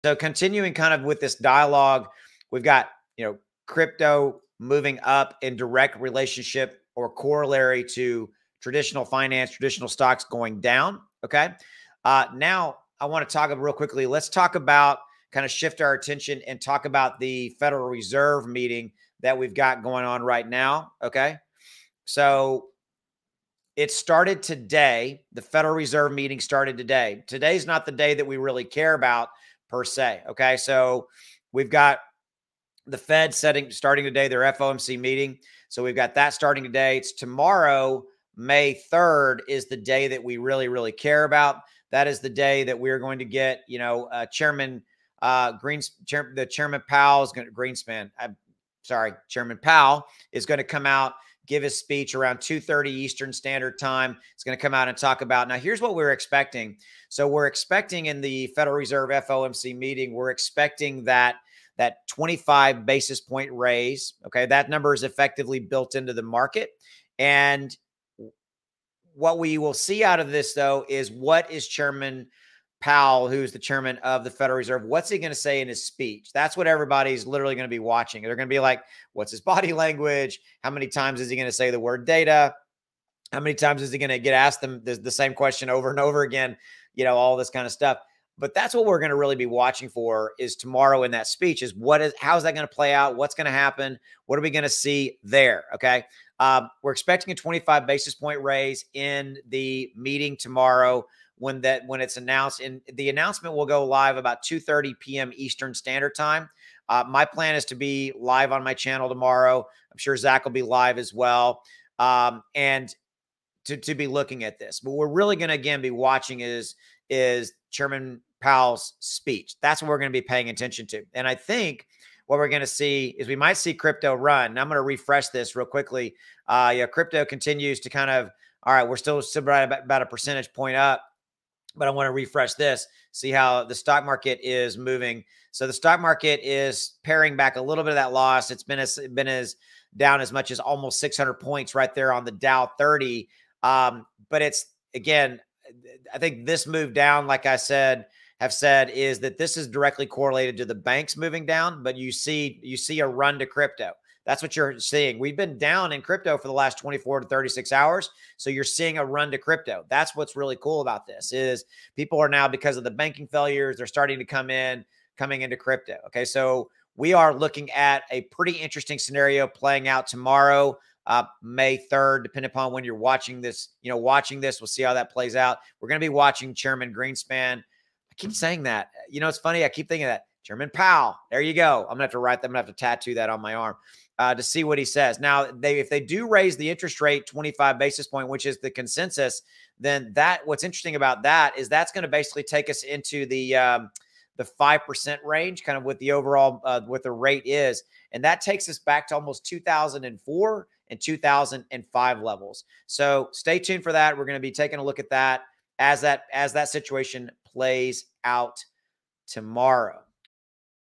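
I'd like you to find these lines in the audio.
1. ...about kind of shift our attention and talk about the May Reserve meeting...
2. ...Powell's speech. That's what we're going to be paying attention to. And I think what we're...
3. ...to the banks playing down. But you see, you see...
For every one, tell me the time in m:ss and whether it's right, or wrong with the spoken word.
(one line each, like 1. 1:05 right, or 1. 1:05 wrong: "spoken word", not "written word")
1. 0:14 wrong: "Federal", not "May"
2. 1:58 right
3. 2:30 wrong: "moving", not "playing".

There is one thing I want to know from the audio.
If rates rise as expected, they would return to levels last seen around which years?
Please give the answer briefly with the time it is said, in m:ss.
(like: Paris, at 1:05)
2004 and 2005, at 3:19.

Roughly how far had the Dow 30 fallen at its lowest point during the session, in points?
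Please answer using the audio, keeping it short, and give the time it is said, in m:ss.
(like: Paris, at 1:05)
600, at 2:20.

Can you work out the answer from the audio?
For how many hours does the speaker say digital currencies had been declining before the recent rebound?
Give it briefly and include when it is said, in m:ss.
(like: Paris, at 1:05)
24 to 36 hours, at 2:36.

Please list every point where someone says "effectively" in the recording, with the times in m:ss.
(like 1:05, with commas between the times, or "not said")
1:05.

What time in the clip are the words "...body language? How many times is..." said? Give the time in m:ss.
1:19.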